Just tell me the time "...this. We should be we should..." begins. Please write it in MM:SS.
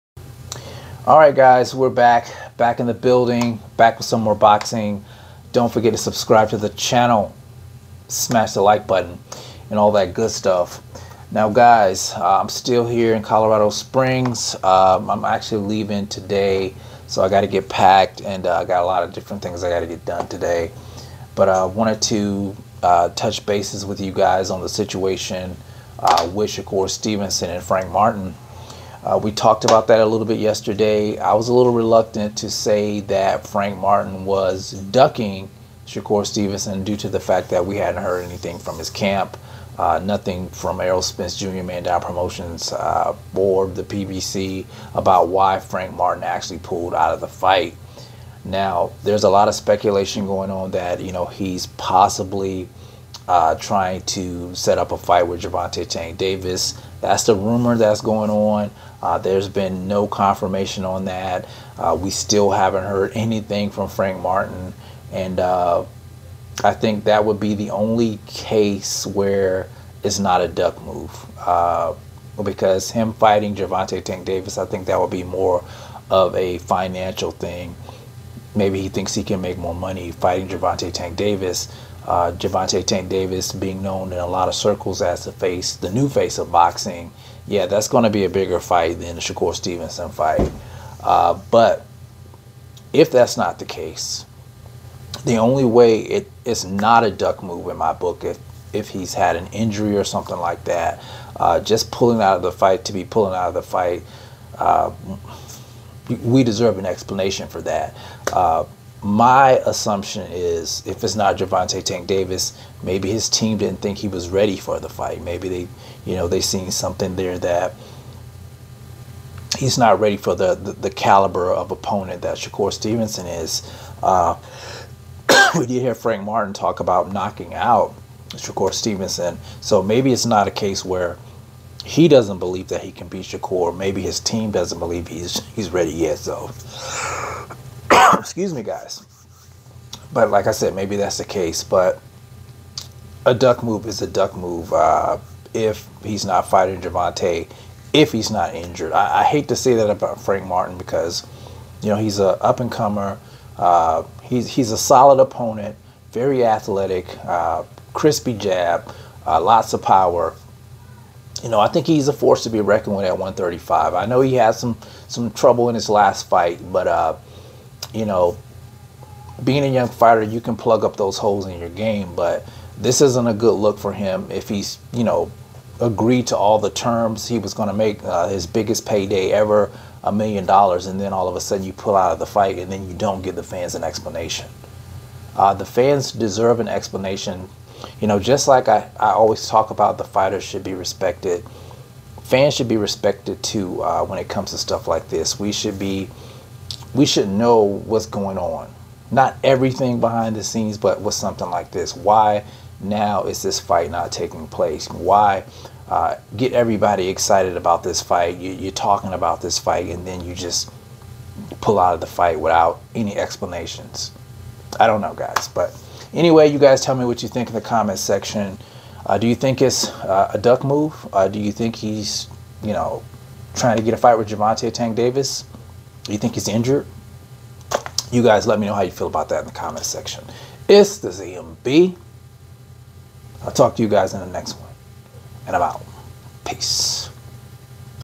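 03:15.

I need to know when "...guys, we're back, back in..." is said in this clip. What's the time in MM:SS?
00:01.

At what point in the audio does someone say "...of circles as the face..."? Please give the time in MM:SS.
01:24.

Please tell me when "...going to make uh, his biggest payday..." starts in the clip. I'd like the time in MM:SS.
02:57.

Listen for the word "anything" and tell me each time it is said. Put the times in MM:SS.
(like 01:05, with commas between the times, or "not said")
00:38, 01:03.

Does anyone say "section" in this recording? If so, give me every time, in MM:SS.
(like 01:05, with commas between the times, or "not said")
03:38, 03:49.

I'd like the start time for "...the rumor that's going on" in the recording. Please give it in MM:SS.
00:57.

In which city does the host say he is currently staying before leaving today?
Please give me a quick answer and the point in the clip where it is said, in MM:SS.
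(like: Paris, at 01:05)
Colorado Springs, at 00:13.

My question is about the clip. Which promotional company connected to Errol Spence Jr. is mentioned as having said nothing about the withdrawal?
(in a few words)
Man Down Promotions.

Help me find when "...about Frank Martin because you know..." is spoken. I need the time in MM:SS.
02:29.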